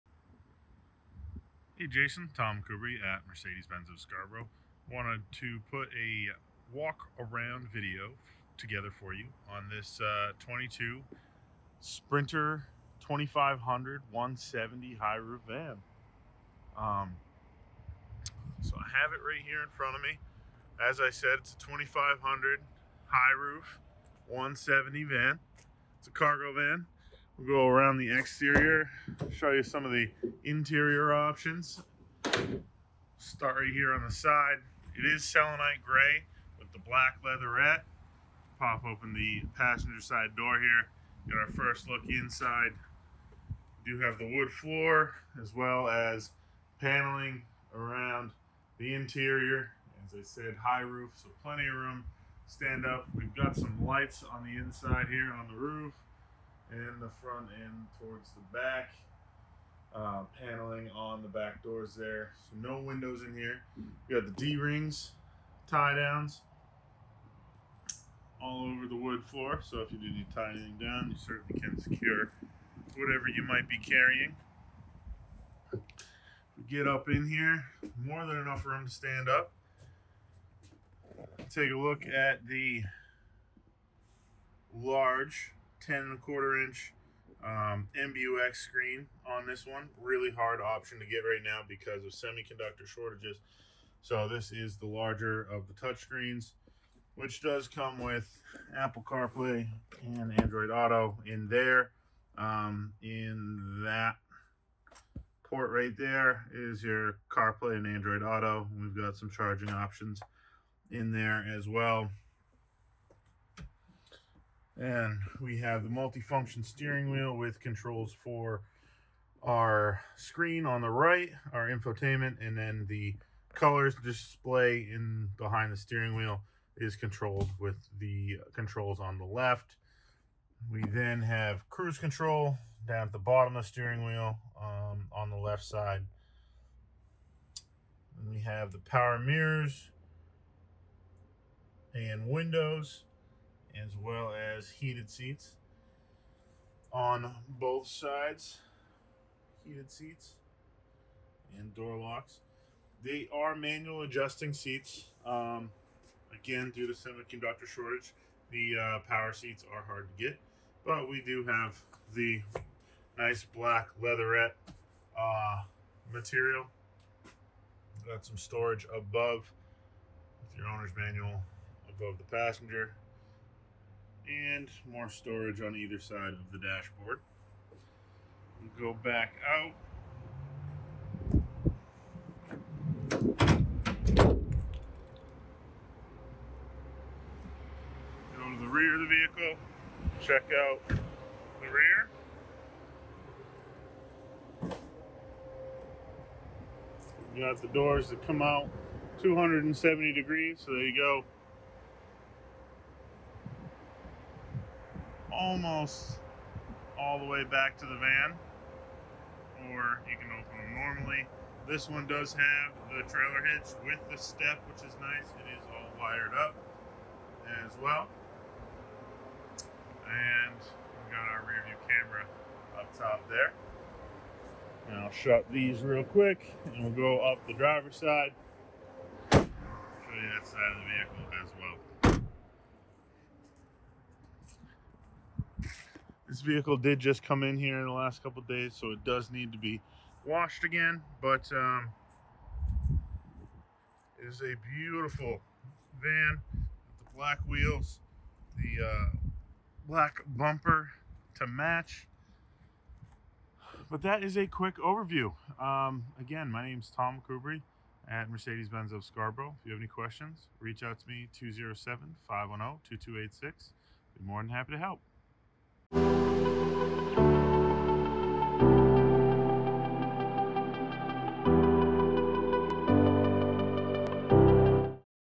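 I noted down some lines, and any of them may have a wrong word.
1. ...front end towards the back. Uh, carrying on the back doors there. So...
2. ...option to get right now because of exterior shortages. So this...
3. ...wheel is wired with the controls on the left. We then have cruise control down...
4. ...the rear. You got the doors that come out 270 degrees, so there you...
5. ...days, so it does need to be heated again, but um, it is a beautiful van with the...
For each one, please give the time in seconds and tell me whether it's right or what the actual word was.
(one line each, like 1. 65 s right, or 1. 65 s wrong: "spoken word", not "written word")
1. 57 s wrong: "paneling", not "carrying"
2. 90 s wrong: "semiconductor", not "exterior"
3. 126 s wrong: "controlled", not "wired"
4. 190 s right
5. 238 s wrong: "washed", not "heated".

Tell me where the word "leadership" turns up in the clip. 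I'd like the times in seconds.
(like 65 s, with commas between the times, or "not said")
not said.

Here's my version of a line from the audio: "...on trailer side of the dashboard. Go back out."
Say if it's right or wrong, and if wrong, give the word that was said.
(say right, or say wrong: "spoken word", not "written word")
wrong: "either", not "trailer".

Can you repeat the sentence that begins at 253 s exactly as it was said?
But that is a quick overview.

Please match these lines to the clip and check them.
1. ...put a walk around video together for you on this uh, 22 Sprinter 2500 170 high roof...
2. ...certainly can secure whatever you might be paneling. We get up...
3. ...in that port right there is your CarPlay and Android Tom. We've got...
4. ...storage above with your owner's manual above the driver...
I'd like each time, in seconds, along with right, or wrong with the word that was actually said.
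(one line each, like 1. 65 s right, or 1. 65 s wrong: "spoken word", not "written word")
1. 5 s right
2. 71 s wrong: "carrying", not "paneling"
3. 103 s wrong: "Auto", not "Tom"
4. 168 s wrong: "passenger", not "driver".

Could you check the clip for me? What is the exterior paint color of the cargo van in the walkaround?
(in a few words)
Selenite gray.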